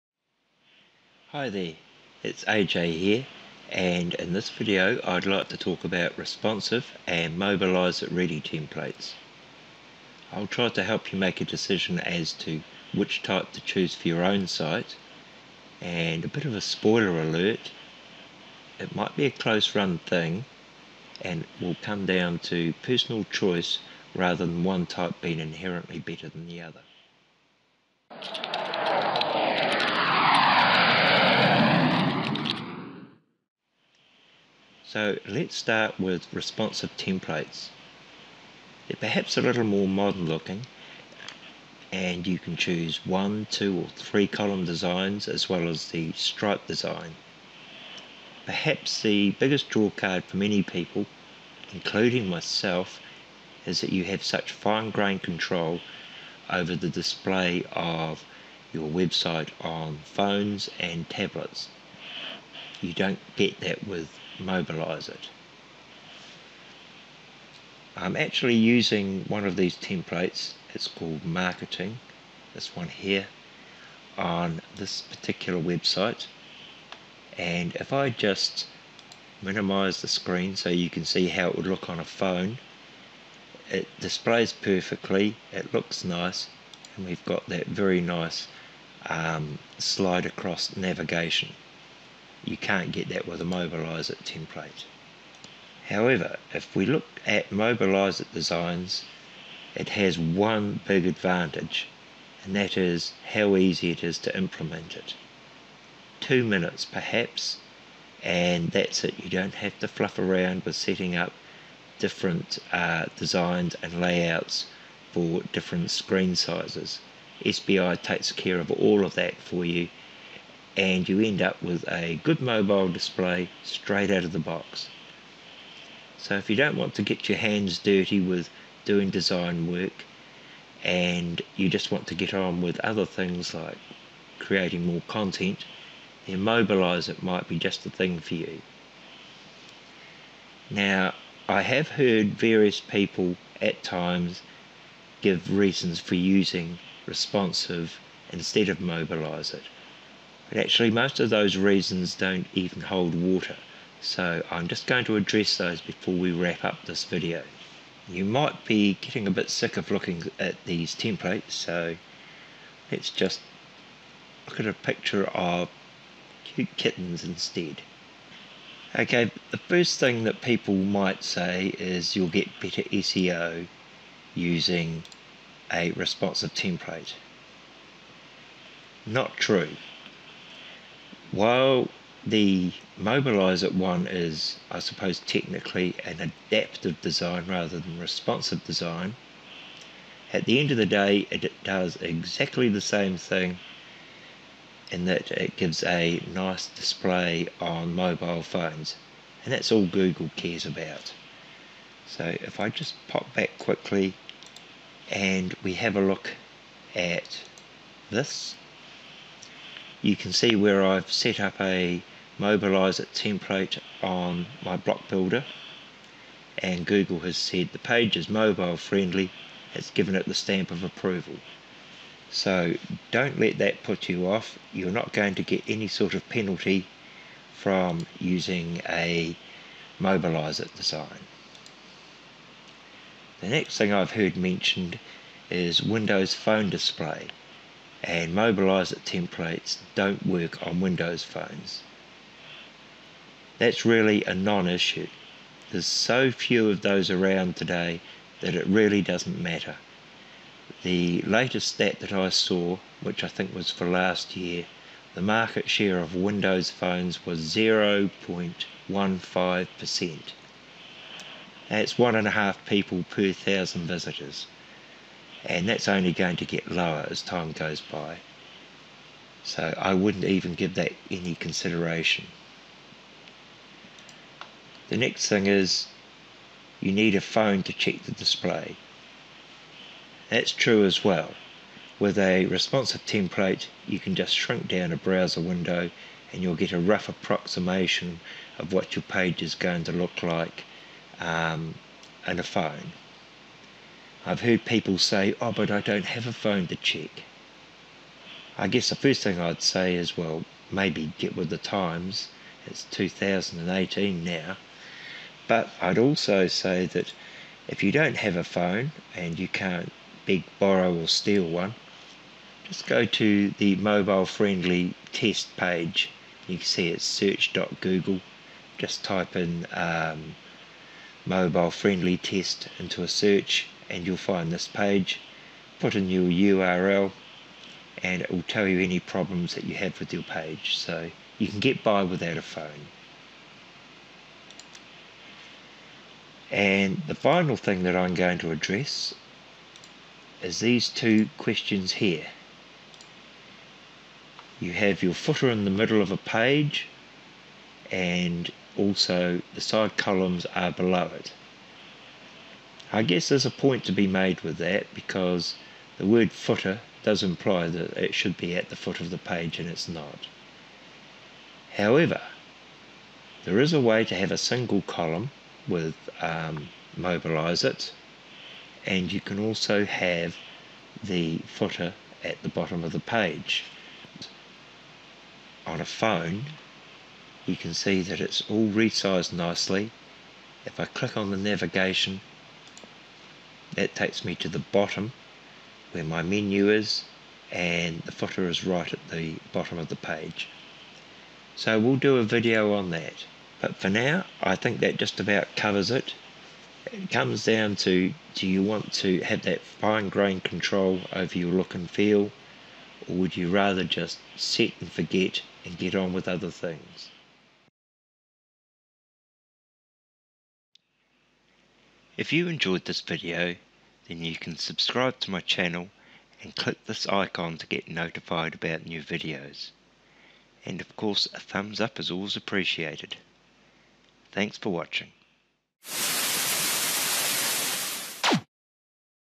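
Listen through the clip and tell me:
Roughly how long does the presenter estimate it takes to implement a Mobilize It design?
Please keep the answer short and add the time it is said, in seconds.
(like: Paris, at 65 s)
2 minutes, at 106 s.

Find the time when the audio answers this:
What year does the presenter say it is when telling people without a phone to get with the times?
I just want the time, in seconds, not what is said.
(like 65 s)
302 s.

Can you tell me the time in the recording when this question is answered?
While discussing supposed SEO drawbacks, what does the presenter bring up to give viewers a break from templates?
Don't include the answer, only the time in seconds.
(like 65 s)
166 s.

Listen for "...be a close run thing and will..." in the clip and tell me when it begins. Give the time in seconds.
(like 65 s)
19 s.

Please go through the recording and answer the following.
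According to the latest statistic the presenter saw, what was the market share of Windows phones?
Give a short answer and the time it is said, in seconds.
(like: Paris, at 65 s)
0.15%, at 257 s.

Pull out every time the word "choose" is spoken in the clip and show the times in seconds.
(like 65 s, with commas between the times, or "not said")
13 s, 42 s.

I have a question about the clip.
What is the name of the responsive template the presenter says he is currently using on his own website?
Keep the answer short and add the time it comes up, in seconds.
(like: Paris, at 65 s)
Marketing, at 71 s.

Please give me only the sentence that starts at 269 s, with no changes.
So I wouldn't even give that any consideration.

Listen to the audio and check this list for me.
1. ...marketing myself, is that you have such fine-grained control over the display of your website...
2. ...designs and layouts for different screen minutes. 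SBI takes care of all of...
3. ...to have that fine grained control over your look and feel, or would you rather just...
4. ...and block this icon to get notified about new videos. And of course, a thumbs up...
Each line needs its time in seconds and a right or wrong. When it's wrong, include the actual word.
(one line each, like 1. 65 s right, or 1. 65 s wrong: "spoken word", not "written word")
1. 51 s wrong: "including", not "marketing"
2. 113 s wrong: "sizes", not "minutes"
3. 398 s right
4. 416 s wrong: "click", not "block".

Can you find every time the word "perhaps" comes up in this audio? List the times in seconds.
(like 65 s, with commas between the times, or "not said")
38 s, 48 s, 106 s.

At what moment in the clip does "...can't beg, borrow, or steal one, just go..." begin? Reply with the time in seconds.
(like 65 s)
309 s.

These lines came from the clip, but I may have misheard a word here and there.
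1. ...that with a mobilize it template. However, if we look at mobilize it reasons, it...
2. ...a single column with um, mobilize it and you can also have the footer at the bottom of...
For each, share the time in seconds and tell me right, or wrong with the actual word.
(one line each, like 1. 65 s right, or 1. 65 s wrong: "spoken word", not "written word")
1. 93 s wrong: "designs", not "reasons"
2. 364 s right.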